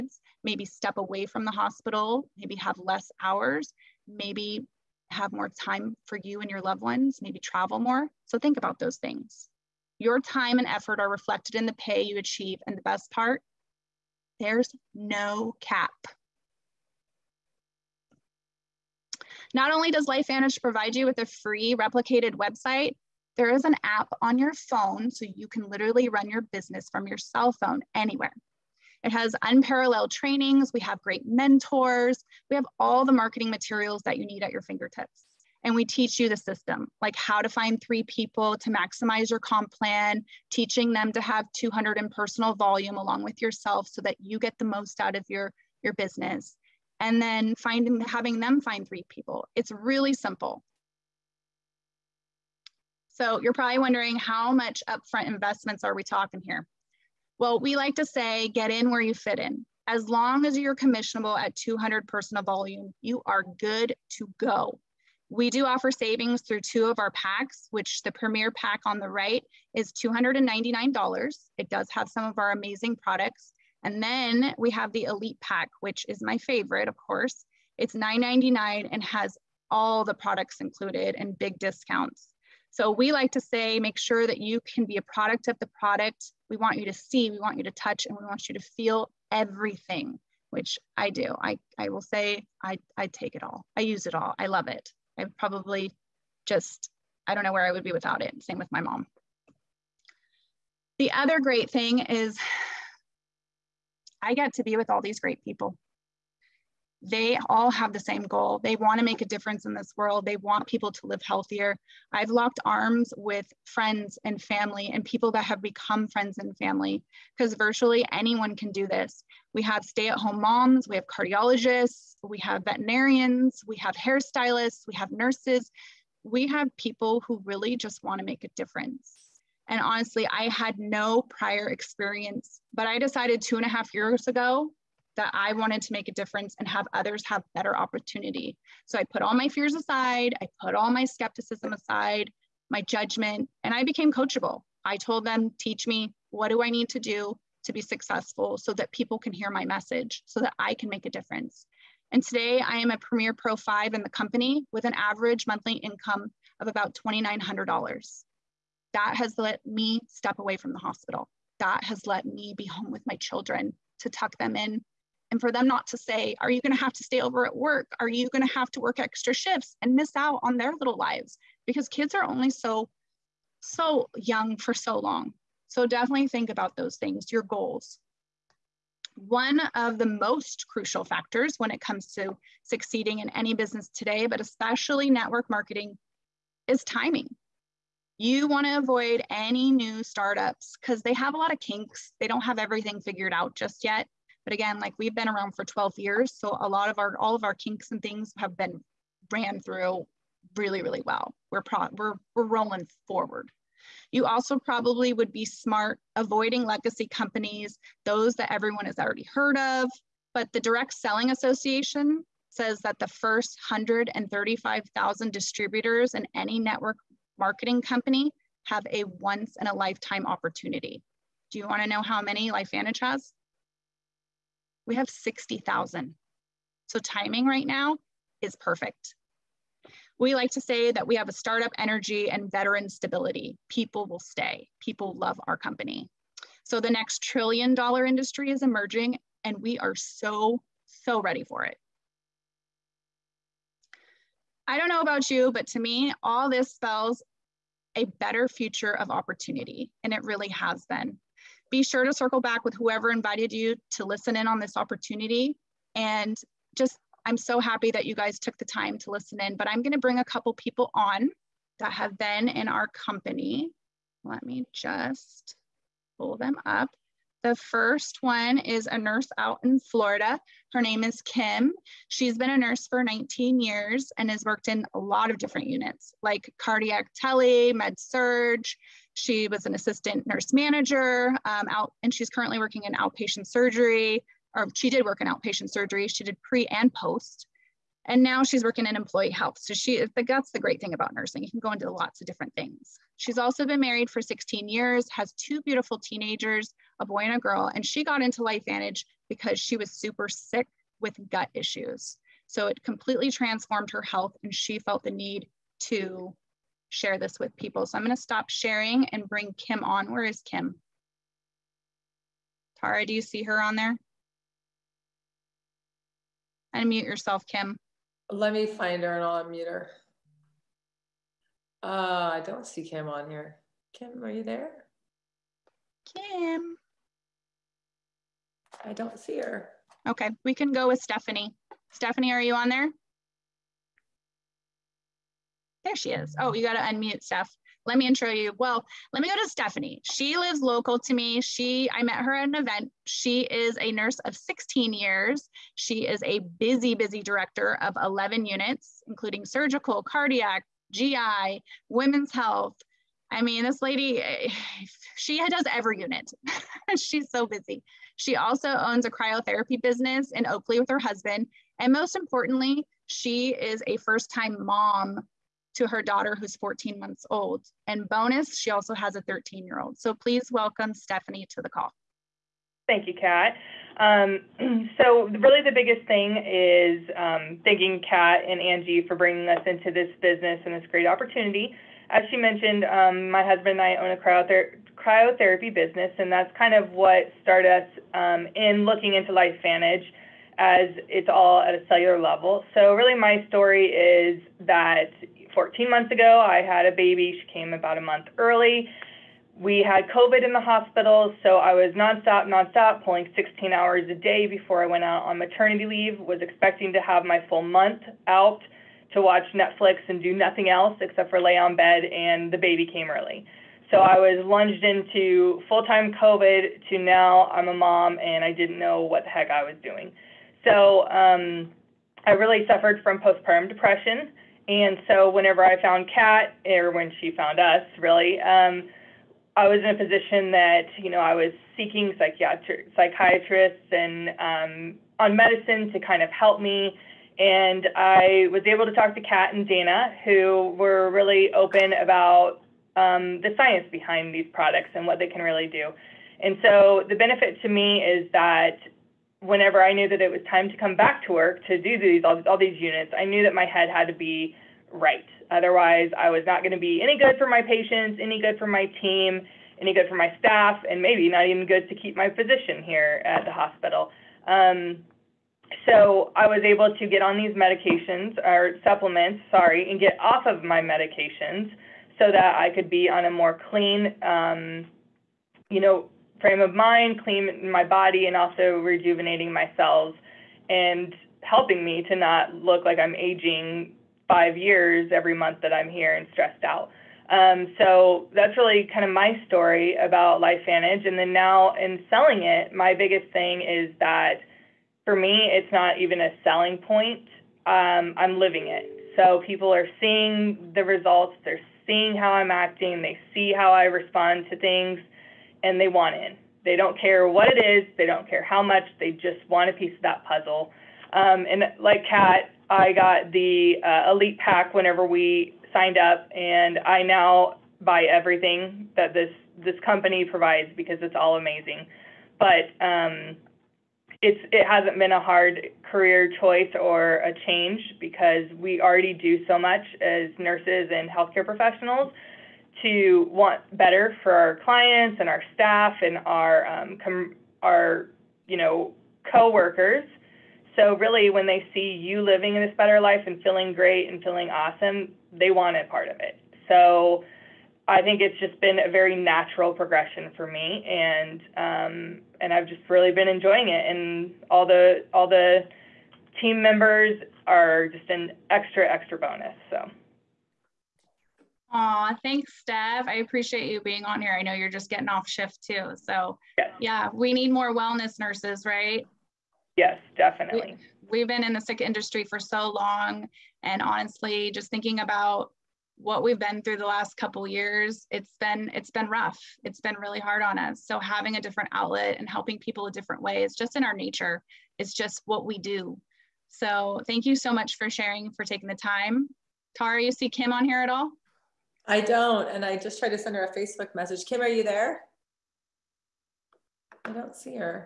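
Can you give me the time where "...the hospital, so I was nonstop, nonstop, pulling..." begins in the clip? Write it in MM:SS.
06:40.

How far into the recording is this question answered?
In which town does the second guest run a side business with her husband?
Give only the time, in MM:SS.
06:00.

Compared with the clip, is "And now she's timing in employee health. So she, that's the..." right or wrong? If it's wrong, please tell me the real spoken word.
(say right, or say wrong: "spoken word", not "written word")
wrong: "working", not "timing".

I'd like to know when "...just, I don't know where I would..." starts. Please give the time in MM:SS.
01:36.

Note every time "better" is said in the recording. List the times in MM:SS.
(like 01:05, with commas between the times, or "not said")
02:17, 04:08, 08:53, 09:02.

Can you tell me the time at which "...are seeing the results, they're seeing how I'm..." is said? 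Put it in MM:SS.
08:19.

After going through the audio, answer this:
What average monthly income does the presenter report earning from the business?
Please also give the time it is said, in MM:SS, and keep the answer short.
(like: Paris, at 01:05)
$2,900, at 02:37.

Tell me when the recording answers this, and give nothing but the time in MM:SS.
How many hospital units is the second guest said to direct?
05:48.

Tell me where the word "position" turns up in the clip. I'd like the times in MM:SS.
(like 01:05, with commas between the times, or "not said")
07:09, 07:42.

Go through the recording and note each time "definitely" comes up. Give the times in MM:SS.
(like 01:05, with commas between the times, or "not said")
02:55, 09:30.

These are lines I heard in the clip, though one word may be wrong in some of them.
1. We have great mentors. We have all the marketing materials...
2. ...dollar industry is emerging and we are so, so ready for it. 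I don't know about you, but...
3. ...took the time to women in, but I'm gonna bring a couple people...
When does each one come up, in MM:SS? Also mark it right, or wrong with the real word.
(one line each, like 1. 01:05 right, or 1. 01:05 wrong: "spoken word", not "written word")
1. 00:30 right
2. 03:57 right
3. 04:18 wrong: "listen", not "women".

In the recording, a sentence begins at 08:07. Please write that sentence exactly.
Um, so that's really kind of my story about LifeVantage.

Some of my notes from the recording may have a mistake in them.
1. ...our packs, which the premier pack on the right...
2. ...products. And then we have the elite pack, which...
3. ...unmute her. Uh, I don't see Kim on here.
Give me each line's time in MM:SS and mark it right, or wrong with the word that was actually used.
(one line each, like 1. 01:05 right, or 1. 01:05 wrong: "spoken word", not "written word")
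1. 01:06 right
2. 01:12 right
3. 05:19 right.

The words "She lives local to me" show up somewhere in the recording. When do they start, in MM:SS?
05:40.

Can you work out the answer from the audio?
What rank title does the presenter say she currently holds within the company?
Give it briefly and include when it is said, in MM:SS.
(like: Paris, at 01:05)
Premier Pro 5, at 02:32.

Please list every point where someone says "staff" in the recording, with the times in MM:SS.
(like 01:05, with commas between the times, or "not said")
07:40, 08:55.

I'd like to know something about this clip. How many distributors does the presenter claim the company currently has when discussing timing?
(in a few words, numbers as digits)
60,000.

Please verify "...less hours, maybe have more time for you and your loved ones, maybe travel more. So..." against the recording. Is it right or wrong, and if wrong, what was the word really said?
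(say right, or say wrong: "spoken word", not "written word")
right.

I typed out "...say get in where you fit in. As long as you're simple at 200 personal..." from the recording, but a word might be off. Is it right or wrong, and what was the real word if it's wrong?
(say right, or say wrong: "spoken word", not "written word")
wrong: "commissionable", not "simple".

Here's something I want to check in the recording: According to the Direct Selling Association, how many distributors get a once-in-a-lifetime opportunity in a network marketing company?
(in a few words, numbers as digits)
135,000.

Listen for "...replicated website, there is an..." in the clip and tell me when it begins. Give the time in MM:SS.
00:21.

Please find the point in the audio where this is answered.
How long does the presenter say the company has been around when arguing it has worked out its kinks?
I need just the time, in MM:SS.
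03:15.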